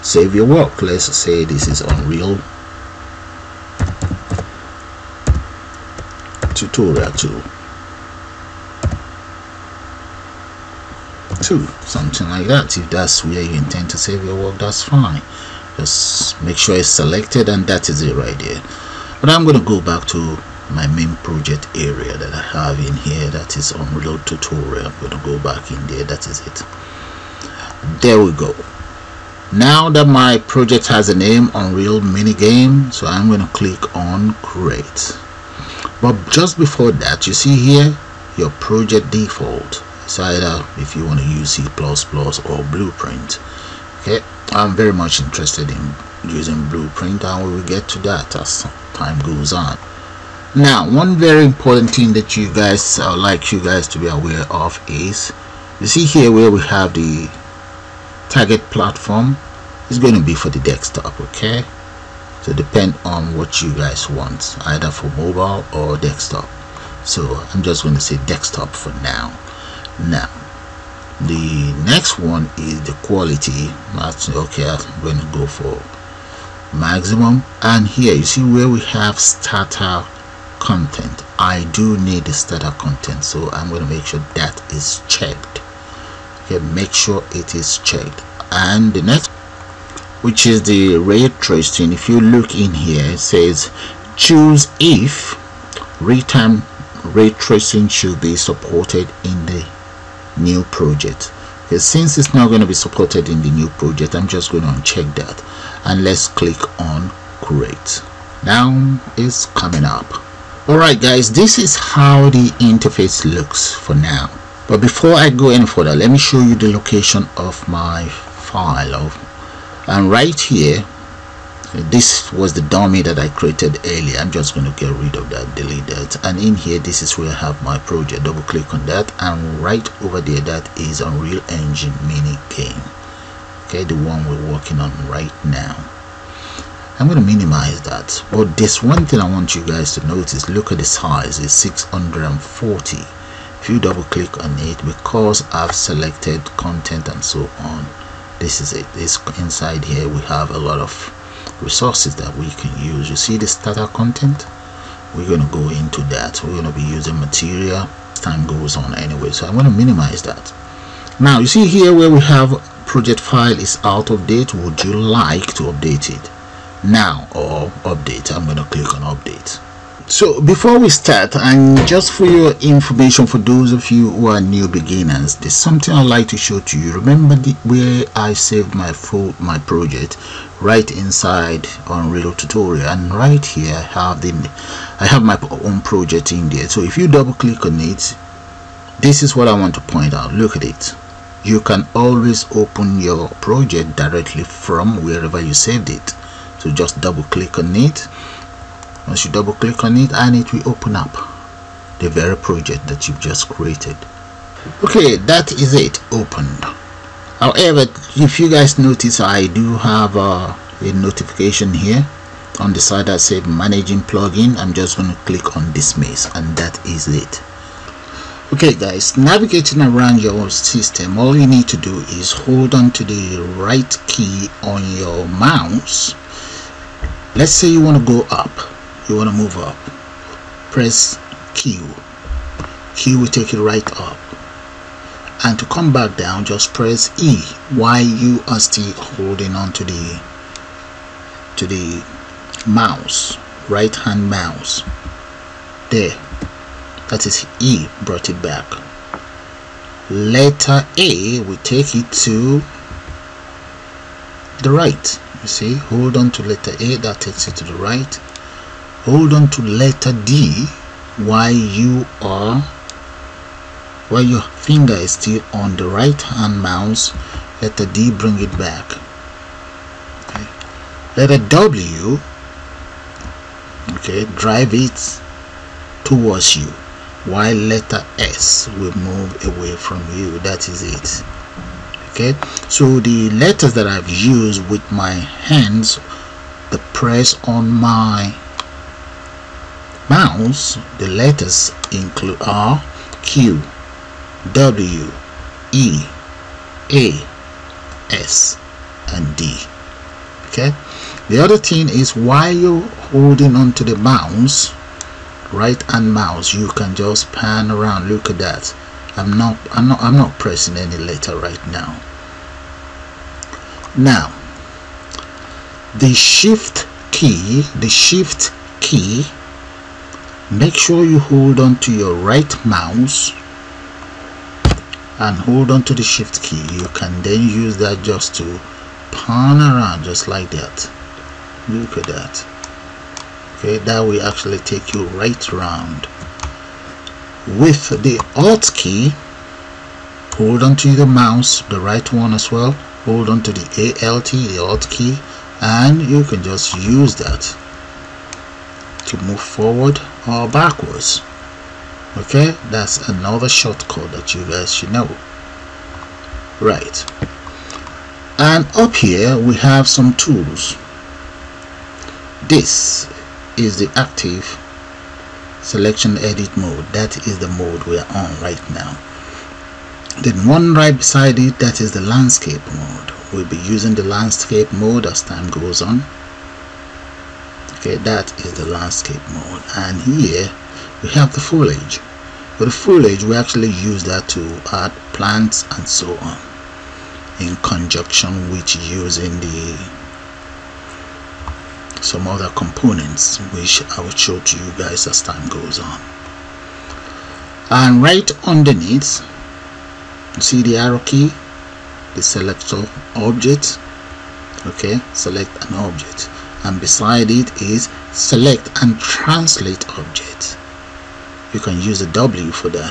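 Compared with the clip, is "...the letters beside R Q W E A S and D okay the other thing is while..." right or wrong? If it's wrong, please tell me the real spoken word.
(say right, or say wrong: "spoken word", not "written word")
wrong: "include", not "beside".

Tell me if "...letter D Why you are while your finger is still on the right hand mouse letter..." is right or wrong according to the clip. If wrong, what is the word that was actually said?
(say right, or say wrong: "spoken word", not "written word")
right.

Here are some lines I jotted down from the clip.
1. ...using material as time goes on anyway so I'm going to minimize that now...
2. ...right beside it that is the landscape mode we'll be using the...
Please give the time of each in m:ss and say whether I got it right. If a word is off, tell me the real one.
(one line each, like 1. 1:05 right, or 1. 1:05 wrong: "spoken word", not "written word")
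1. 2:36 right
2. 6:10 right.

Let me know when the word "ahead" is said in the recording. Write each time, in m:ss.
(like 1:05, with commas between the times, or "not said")
not said.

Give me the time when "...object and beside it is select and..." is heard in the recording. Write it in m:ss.
6:45.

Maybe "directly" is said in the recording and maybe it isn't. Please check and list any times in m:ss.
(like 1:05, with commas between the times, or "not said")
3:13.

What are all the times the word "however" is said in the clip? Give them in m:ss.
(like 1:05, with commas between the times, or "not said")
3:27.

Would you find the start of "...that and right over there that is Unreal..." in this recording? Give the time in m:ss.
2:08.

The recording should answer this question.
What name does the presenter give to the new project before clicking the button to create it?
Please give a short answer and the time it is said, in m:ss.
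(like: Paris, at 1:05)
Unreal minigame, at 0:31.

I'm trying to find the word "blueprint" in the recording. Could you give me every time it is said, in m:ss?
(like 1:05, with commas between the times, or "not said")
0:42, 0:46.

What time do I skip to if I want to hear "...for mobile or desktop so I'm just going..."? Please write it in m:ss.
1:04.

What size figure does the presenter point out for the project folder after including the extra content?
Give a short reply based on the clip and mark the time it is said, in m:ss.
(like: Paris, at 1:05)
640, at 2:21.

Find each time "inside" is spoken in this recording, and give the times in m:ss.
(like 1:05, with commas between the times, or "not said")
2:29, 3:00.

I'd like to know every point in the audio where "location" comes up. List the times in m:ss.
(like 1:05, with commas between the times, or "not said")
1:56.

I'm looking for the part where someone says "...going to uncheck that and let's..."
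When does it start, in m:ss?
1:44.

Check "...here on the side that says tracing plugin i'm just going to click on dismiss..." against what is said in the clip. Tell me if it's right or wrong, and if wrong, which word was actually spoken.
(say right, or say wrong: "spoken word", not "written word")
wrong: "managing", not "tracing".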